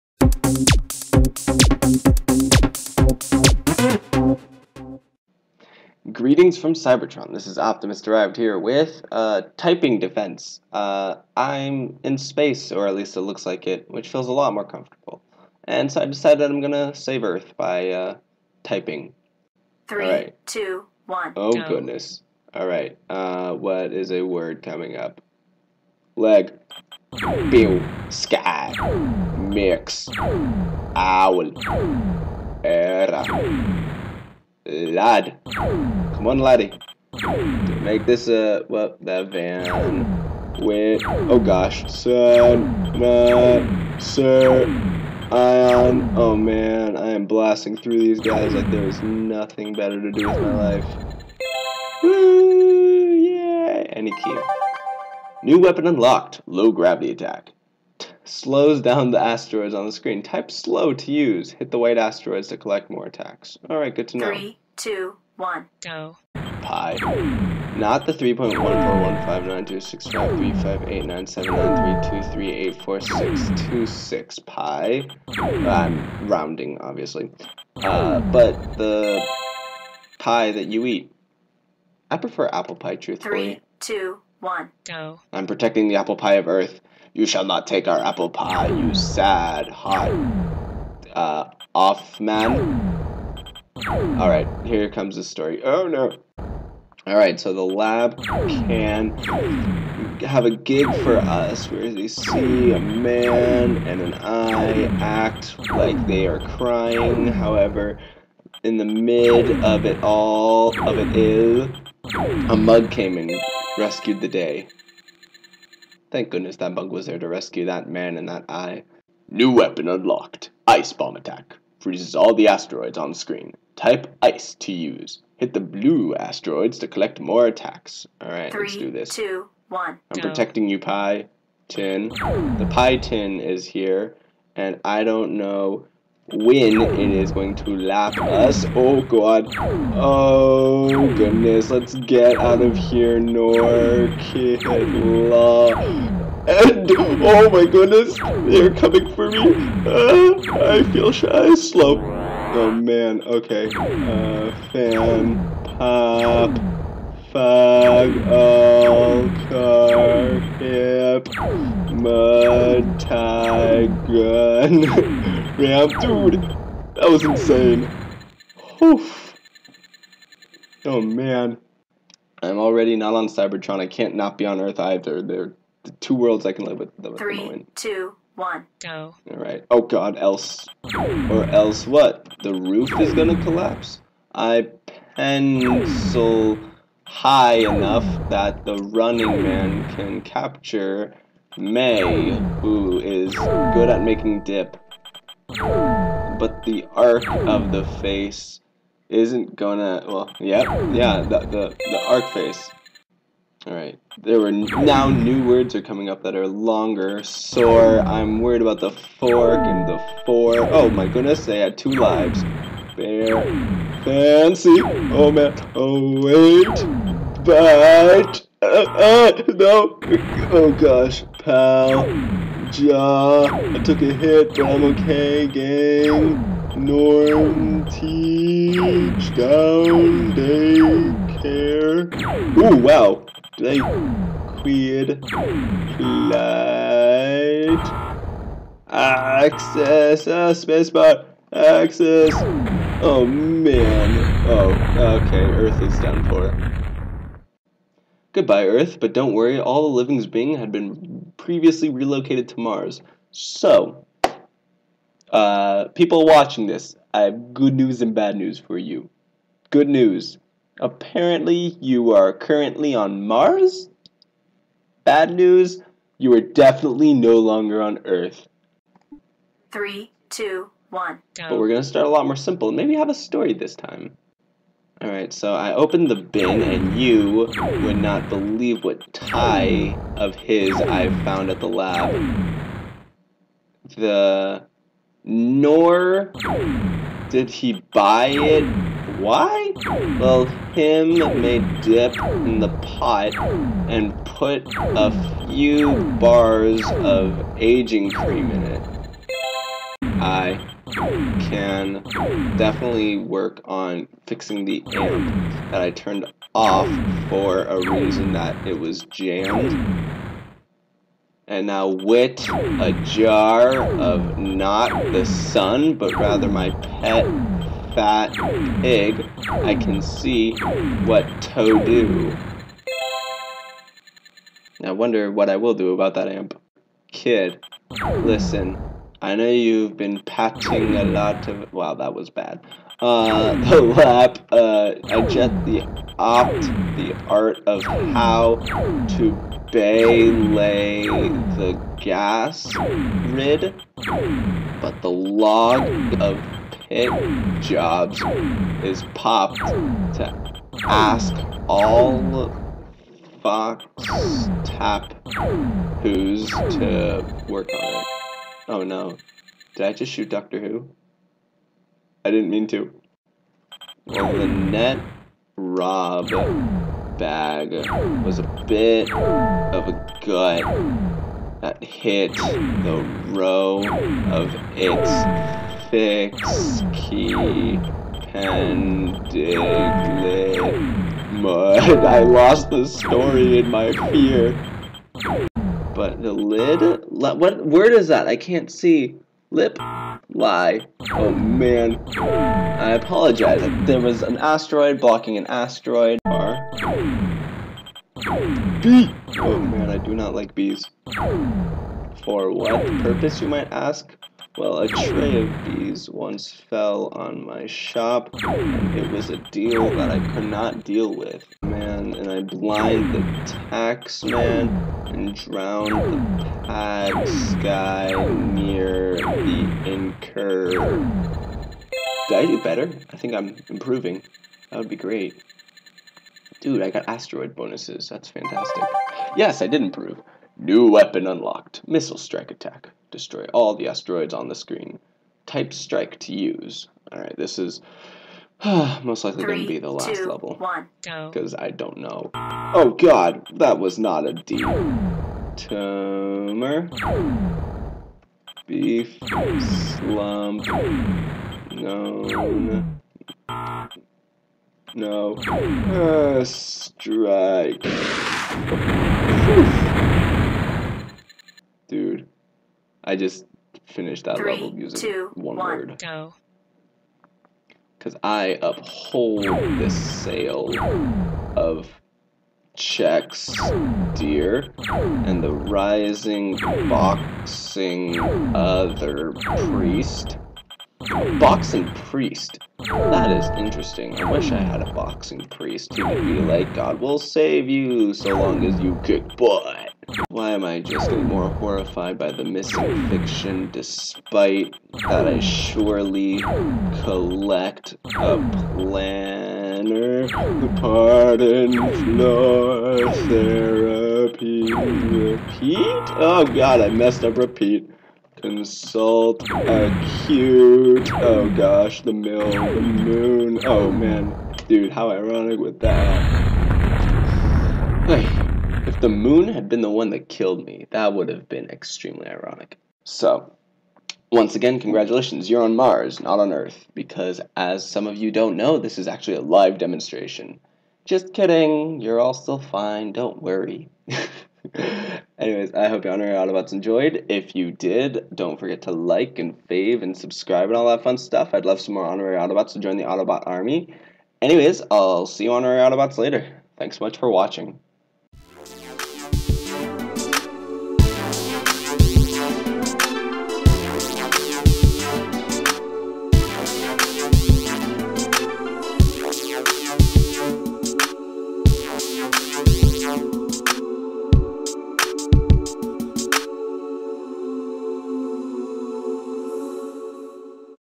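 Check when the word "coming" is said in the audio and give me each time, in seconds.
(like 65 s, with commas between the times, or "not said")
24 s, 148 s, 205 s.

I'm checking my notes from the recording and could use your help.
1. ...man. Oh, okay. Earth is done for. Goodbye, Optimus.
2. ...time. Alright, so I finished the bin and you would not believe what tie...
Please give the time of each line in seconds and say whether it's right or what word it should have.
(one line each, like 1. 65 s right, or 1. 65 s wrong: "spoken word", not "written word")
1. 243 s wrong: "Earth", not "Optimus"
2. 273 s wrong: "opened", not "finished".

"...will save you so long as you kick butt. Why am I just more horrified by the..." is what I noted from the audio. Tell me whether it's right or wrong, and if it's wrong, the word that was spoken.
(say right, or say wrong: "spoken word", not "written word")
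right.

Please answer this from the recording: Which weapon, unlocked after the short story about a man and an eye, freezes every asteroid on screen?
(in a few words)
Ice bomb attack.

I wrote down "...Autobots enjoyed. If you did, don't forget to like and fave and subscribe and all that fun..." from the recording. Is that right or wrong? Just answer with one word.
right.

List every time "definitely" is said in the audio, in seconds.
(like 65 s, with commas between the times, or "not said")
266 s, 302 s.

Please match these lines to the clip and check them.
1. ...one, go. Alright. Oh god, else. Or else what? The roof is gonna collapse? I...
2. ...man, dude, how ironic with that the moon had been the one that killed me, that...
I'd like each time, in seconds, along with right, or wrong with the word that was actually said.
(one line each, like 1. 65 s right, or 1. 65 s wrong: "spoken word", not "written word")
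1. 178 s right
2. 513 s right.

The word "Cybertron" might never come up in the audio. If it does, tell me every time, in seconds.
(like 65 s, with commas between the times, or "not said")
6 s, 173 s.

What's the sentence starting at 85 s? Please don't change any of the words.
I'm protecting the apple pie of Earth.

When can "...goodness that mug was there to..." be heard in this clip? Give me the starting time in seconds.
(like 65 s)
116 s.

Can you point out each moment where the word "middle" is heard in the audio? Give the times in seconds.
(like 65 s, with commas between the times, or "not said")
not said.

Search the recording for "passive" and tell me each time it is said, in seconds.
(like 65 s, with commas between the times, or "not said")
not said.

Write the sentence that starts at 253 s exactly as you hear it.
So, uh, people watching this, I have good news and bad news for you.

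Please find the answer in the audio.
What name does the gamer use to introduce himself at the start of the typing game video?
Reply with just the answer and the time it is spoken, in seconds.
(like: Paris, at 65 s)
Optimus Derived, at 7 s.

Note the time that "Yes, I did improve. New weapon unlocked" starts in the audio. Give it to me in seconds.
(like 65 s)
429 s.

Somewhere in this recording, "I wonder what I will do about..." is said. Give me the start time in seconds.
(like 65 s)
324 s.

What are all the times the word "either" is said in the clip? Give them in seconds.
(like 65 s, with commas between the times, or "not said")
174 s.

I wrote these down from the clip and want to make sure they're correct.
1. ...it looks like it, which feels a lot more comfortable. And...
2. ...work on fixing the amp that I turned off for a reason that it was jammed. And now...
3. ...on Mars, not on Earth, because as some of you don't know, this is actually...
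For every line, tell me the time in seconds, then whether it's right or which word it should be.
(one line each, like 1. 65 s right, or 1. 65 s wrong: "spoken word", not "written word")
1. 13 s right
2. 303 s right
3. 525 s right.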